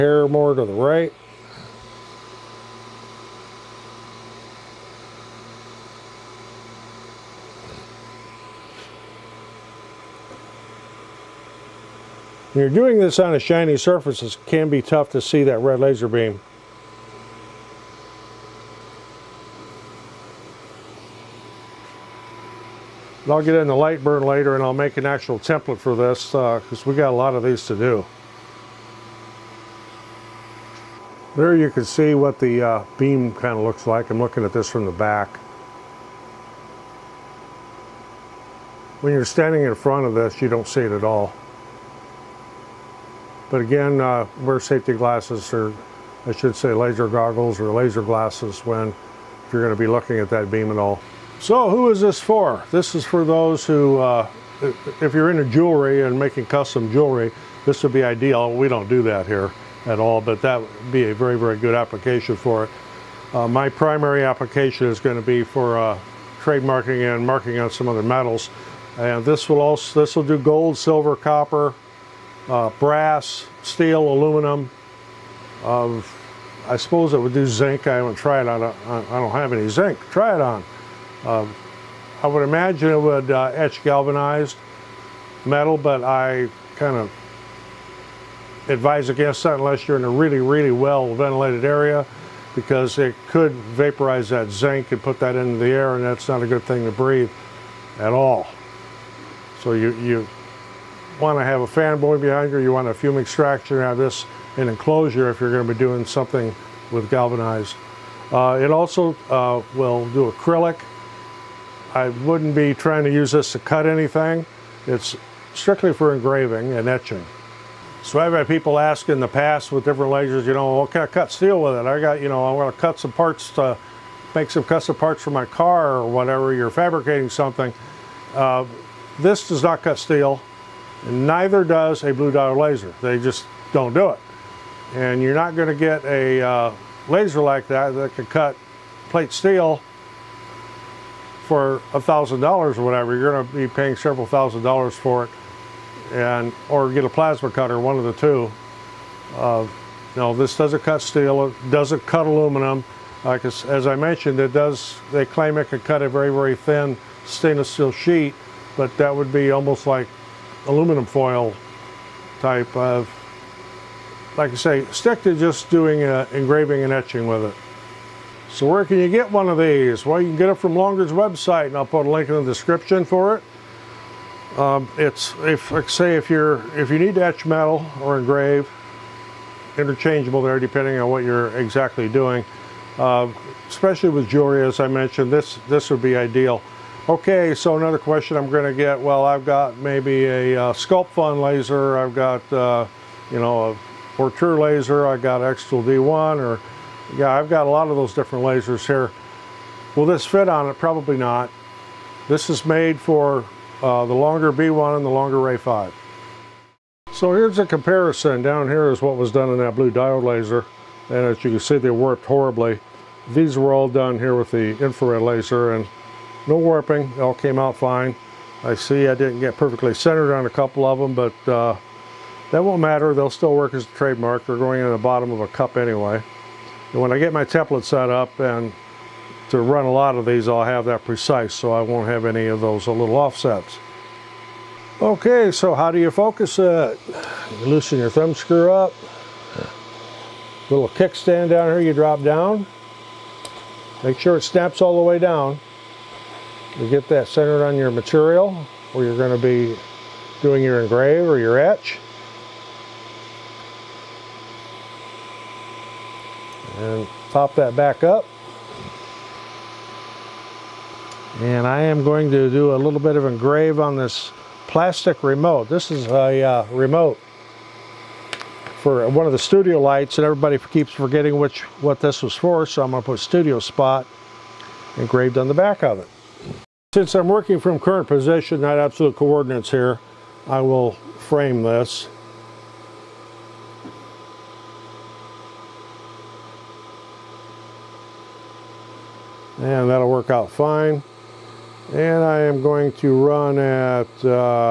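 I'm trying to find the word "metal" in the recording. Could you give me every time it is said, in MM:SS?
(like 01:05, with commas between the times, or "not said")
01:08, 01:25, 02:57.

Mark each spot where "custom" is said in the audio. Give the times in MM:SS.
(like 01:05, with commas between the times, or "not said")
00:56, 02:04.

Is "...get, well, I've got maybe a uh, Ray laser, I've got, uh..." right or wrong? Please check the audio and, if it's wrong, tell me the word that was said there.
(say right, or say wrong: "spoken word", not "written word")
wrong: "Sculpfun", not "Ray".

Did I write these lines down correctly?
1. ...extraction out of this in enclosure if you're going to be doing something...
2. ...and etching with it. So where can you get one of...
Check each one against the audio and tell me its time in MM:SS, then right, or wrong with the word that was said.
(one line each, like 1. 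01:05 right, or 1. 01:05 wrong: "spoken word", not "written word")
1. 01:43 right
2. 02:46 right.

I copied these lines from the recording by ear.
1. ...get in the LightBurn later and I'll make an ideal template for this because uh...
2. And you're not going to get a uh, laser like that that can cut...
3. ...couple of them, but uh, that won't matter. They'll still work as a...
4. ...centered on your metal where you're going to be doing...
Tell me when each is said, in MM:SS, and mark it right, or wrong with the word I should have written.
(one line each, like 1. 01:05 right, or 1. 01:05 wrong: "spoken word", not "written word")
1. 00:23 wrong: "actual", not "ideal"
2. 02:14 right
3. 03:40 right
4. 04:07 wrong: "material", not "metal".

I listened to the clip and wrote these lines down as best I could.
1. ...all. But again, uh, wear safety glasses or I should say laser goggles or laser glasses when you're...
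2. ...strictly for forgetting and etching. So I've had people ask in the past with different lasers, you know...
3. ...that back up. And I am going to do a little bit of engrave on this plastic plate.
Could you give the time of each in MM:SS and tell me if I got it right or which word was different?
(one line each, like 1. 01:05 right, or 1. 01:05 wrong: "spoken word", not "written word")
1. 00:41 right
2. 01:55 wrong: "engraving", not "forgetting"
3. 04:17 wrong: "remote", not "plate".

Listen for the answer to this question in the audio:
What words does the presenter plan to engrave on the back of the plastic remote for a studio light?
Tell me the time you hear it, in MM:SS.
04:33.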